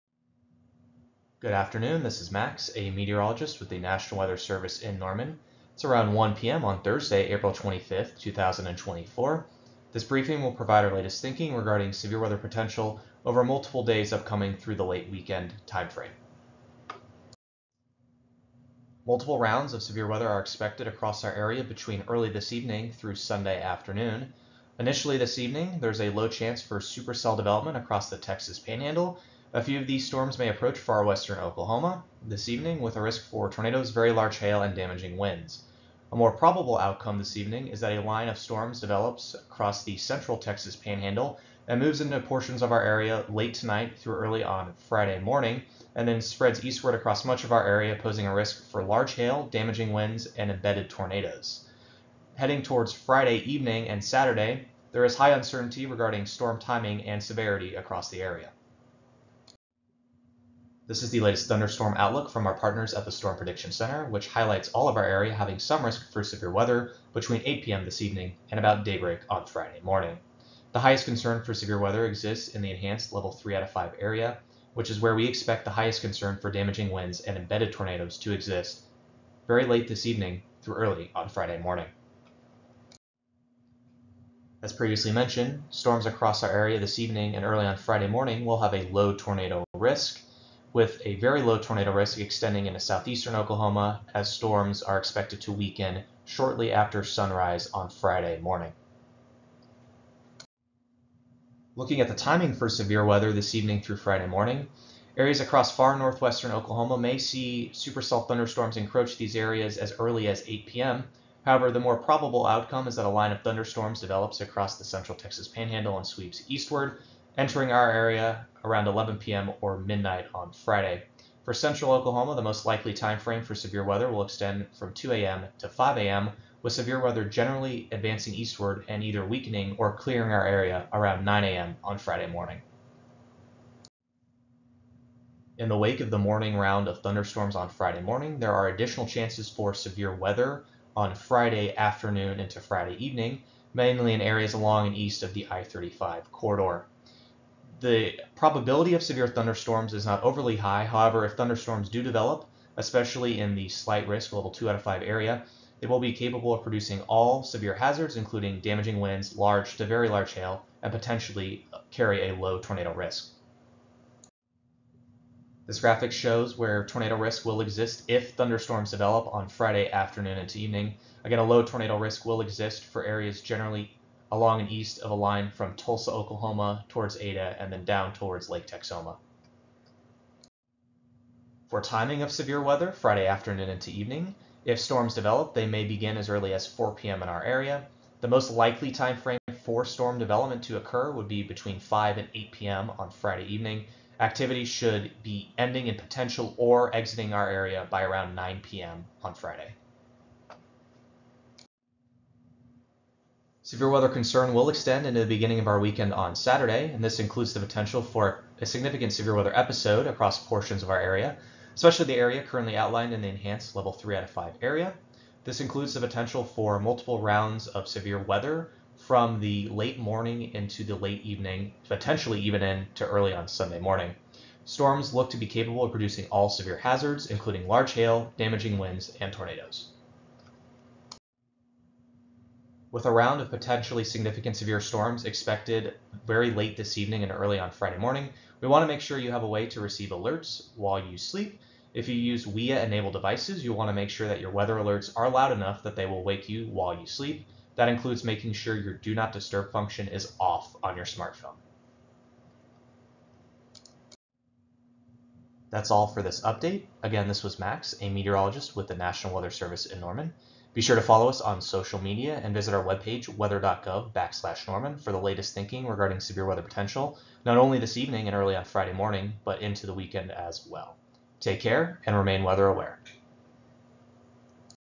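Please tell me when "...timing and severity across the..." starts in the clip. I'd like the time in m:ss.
0:56.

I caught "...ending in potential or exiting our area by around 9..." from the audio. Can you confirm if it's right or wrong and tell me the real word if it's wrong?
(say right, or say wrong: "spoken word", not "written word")
right.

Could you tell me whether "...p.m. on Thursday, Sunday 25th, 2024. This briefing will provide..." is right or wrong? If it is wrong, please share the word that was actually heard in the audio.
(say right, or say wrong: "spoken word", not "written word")
wrong: "April", not "Sunday".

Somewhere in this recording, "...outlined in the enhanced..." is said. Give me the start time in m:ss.
3:32.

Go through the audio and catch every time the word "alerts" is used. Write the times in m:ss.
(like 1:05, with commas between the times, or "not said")
4:00, 4:04.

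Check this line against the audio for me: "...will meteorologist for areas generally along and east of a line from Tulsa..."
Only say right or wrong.
wrong.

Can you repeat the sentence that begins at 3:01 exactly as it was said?
For timing of severe weather, Friday afternoon into evening.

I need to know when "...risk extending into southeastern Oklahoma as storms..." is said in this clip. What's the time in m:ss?
1:31.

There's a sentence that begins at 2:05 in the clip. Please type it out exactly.
to 5 a.m., with severe weather generally advancing eastward and either weakening or clearing our area around 9 a.m.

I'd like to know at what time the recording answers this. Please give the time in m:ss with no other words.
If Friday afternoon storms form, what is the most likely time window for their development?
3:11.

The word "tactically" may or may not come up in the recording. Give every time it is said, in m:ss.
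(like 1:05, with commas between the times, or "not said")
not said.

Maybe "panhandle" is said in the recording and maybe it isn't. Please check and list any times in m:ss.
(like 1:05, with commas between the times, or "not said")
0:28, 0:40, 1:55.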